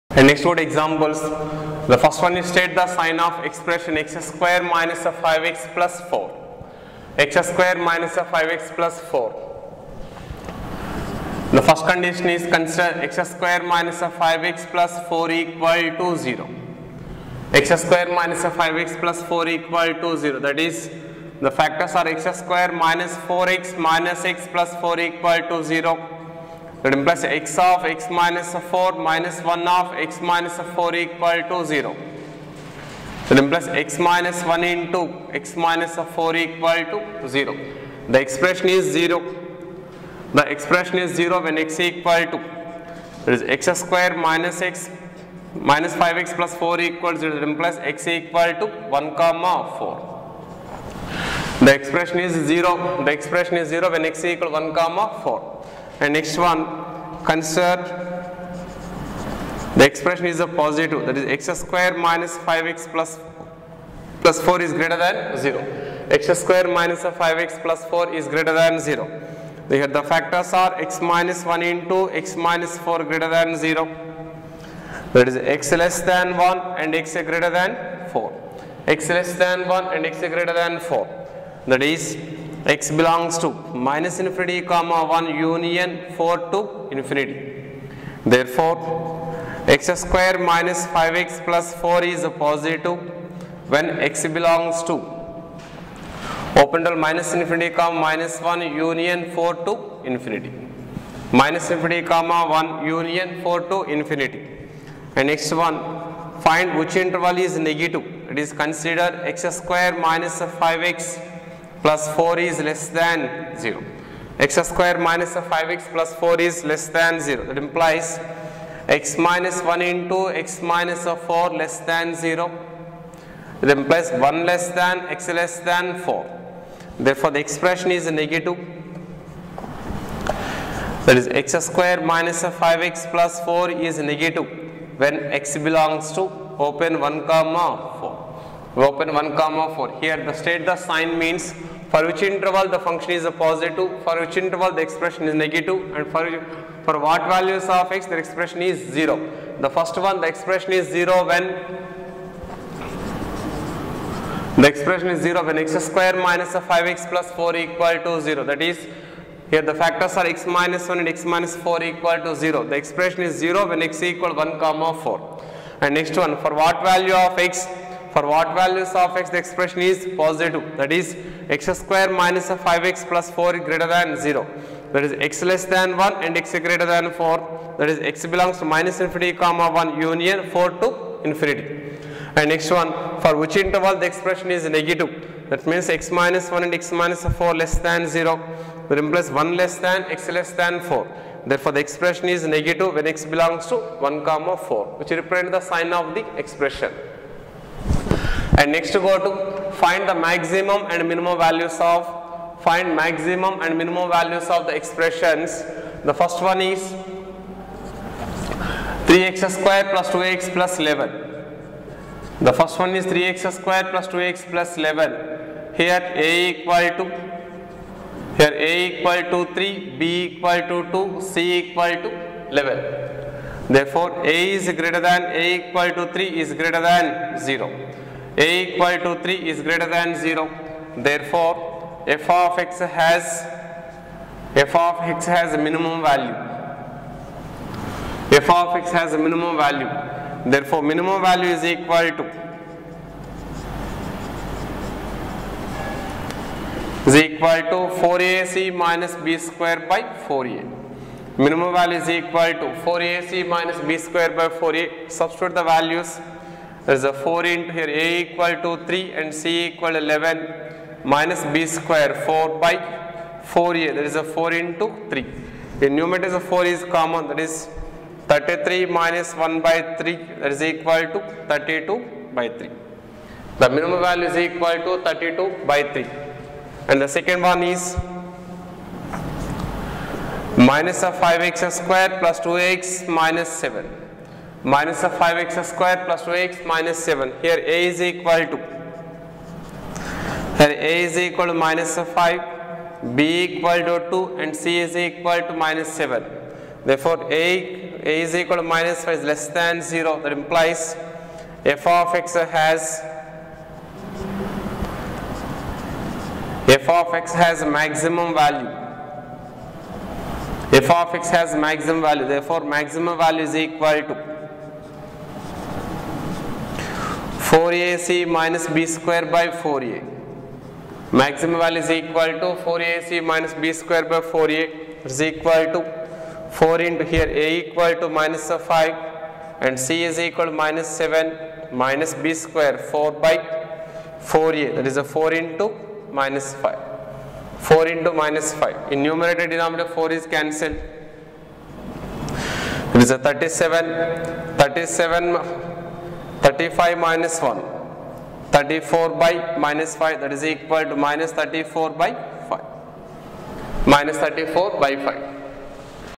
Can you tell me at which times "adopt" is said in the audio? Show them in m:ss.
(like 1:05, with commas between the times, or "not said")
not said.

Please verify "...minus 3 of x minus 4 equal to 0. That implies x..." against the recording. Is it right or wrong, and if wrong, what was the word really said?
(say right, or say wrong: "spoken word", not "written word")
wrong: "1", not "3".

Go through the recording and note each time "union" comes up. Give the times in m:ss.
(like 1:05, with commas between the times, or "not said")
1:25, 1:38, 1:42, 3:00.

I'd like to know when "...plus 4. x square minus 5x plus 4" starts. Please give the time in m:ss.
0:05.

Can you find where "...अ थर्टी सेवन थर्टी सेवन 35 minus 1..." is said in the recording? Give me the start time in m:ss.
5:43.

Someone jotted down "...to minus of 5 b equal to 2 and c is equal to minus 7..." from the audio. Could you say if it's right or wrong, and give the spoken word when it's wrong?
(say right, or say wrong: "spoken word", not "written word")
right.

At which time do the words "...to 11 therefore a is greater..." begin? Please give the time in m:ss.
3:42.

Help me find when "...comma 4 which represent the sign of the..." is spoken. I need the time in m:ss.
3:14.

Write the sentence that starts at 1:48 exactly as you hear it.
It is considered x square minus 5x plus 4 is less than 0.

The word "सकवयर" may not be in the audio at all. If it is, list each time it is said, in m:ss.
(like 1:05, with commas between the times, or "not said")
5:18, 5:23.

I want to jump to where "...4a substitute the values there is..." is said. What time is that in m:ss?
4:14.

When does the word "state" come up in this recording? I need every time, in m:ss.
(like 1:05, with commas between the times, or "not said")
0:02, 2:20.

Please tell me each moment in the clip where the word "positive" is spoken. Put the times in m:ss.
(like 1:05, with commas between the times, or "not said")
1:00, 1:32, 2:23, 2:50.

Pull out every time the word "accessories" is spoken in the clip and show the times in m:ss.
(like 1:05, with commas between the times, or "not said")
not said.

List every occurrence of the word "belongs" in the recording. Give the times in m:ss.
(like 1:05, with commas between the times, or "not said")
1:22, 1:34, 2:15, 2:58, 3:13.